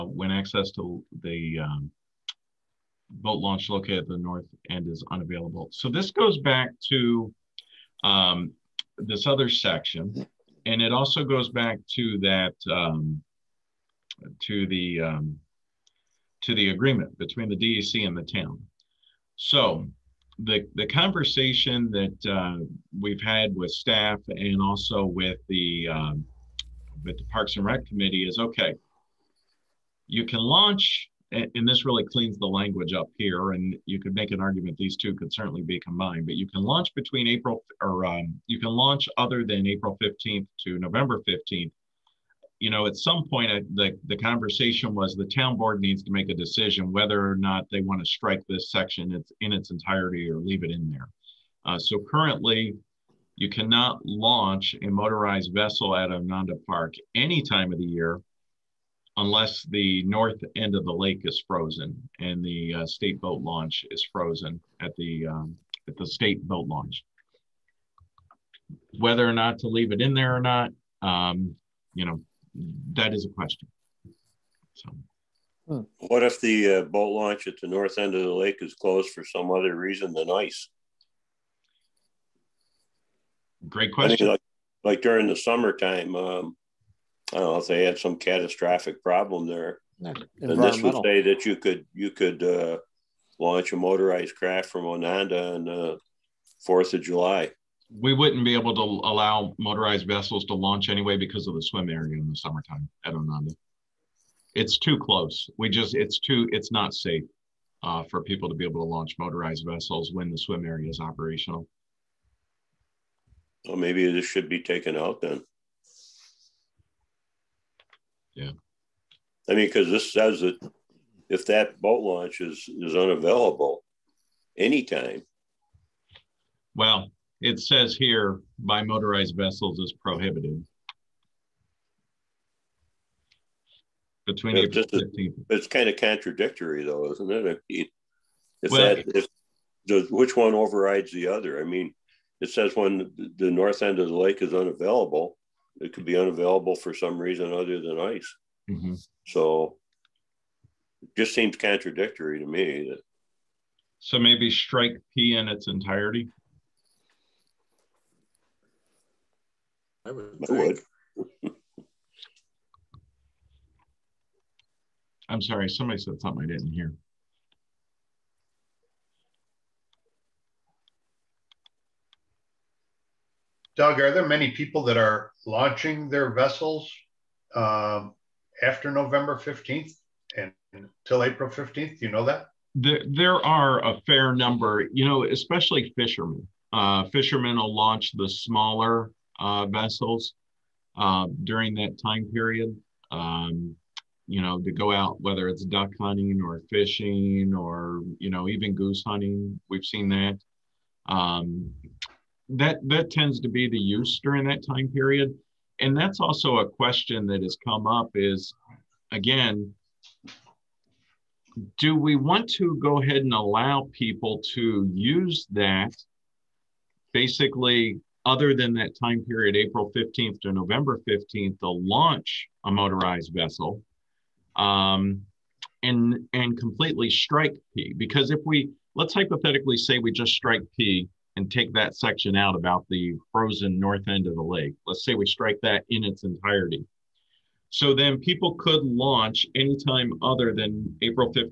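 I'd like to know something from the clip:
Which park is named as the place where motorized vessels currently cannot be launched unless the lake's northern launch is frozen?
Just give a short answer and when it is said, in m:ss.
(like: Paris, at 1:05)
Onanda Park, at 0:56.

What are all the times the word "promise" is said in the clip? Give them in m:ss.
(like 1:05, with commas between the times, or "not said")
not said.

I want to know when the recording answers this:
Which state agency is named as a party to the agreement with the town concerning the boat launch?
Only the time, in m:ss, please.
0:17.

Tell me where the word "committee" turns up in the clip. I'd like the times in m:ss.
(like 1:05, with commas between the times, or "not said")
0:27.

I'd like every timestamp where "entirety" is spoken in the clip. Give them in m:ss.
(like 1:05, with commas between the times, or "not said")
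0:49, 2:35, 3:56.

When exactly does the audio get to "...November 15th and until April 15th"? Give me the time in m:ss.
2:58.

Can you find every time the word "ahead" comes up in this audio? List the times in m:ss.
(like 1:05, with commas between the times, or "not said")
3:33.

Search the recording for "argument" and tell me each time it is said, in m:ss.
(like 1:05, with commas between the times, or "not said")
0:34.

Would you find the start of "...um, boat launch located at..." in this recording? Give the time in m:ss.
0:01.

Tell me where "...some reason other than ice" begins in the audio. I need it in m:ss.
2:26.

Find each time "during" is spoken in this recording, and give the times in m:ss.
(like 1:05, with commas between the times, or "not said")
1:25, 3:11, 3:24.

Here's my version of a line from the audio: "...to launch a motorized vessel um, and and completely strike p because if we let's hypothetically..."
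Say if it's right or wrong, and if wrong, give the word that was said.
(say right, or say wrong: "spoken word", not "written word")
right.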